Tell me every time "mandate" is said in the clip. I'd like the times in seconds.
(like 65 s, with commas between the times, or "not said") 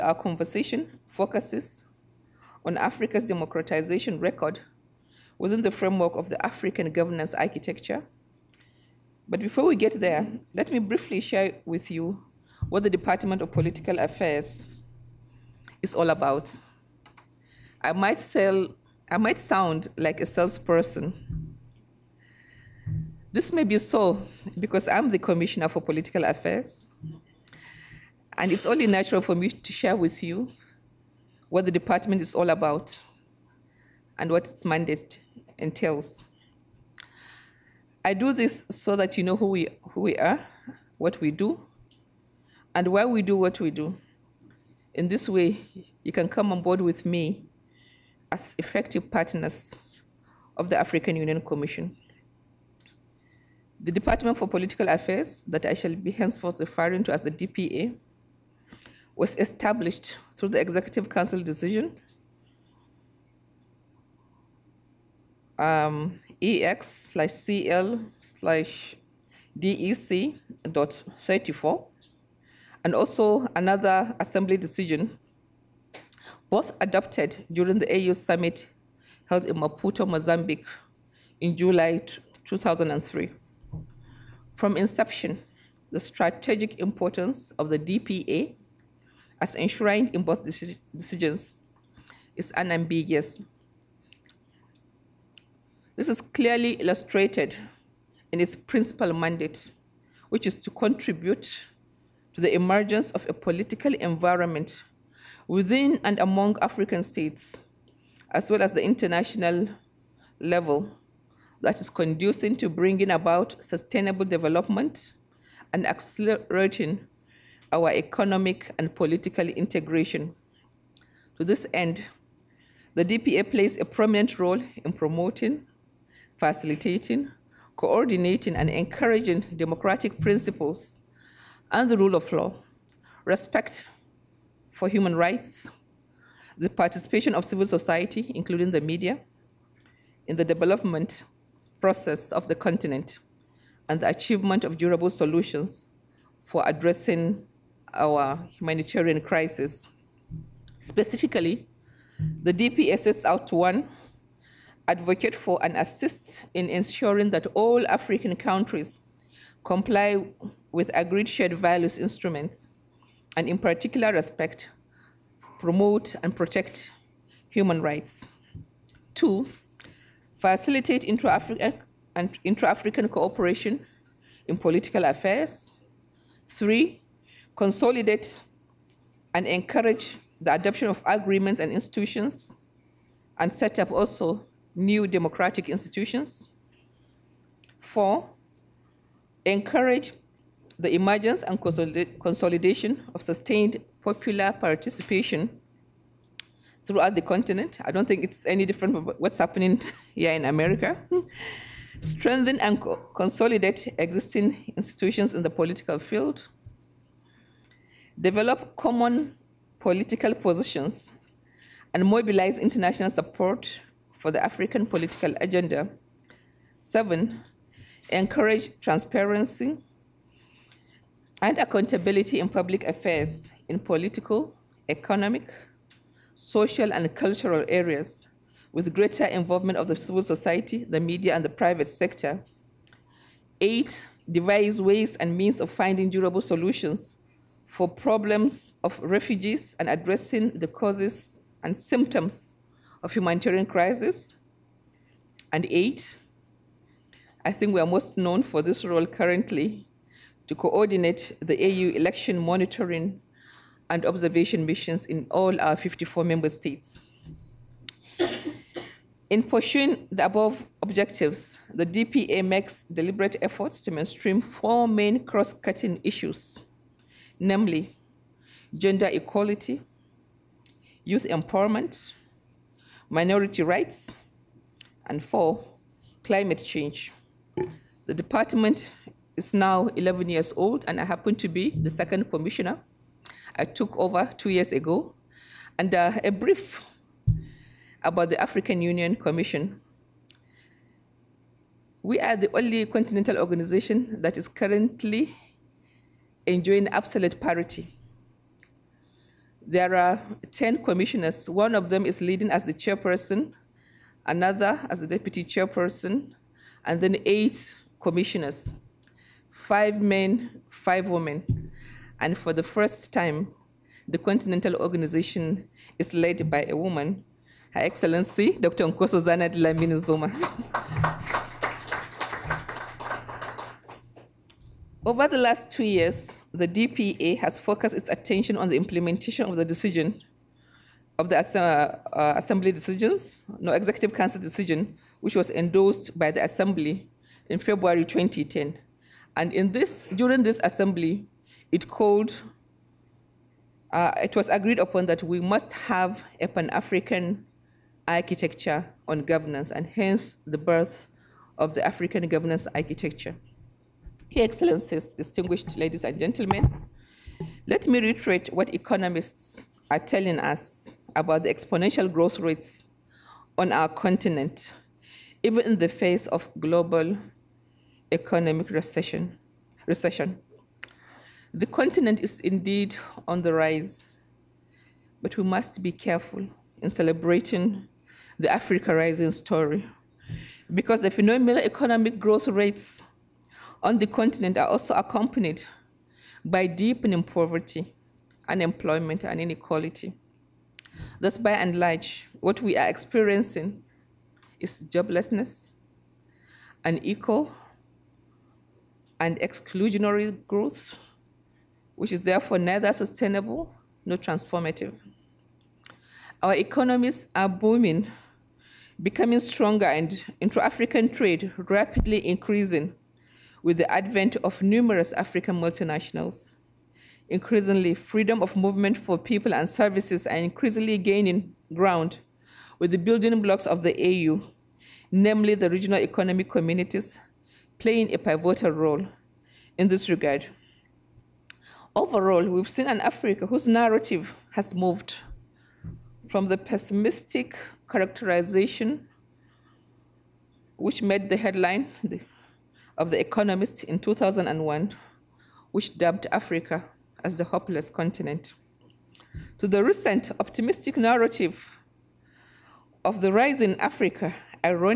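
34 s, 99 s.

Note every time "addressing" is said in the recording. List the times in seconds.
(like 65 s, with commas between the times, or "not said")
146 s, 239 s.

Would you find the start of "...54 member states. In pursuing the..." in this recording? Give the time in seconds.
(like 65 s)
255 s.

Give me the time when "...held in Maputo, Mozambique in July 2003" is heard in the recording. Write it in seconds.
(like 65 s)
79 s.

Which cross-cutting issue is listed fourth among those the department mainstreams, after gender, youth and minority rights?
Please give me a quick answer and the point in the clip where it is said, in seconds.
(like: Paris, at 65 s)
Climate change, at 276 s.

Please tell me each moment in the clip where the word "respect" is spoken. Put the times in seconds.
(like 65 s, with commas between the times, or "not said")
133 s, 164 s.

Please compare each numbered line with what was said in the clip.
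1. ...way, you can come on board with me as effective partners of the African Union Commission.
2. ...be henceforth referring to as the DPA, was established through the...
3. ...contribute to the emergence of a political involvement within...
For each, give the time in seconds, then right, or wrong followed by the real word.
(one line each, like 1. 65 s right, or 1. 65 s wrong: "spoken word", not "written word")
1. 45 s right
2. 55 s right
3. 100 s wrong: "environment", not "involvement".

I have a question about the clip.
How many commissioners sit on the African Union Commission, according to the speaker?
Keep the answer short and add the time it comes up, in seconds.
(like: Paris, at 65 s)
10, at 300 s.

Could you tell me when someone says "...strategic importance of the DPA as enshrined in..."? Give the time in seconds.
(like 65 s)
85 s.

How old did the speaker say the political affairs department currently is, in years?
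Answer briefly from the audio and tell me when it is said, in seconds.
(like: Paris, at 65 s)
11, at 279 s.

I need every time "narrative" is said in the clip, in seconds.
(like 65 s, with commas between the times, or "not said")
433 s, 450 s.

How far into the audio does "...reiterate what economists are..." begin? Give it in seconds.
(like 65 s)
357 s.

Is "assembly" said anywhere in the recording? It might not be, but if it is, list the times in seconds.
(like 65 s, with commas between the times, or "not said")
74 s, 332 s, 336 s, 340 s.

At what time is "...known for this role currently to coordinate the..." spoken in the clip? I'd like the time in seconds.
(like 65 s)
248 s.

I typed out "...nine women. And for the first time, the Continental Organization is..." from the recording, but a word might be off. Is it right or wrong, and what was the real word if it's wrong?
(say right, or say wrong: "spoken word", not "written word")
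wrong: "five", not "nine".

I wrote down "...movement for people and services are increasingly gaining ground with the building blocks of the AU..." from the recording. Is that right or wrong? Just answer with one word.
right.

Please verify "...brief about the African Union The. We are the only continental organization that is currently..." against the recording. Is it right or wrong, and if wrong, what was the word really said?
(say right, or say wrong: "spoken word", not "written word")
wrong: "Commission", not "The".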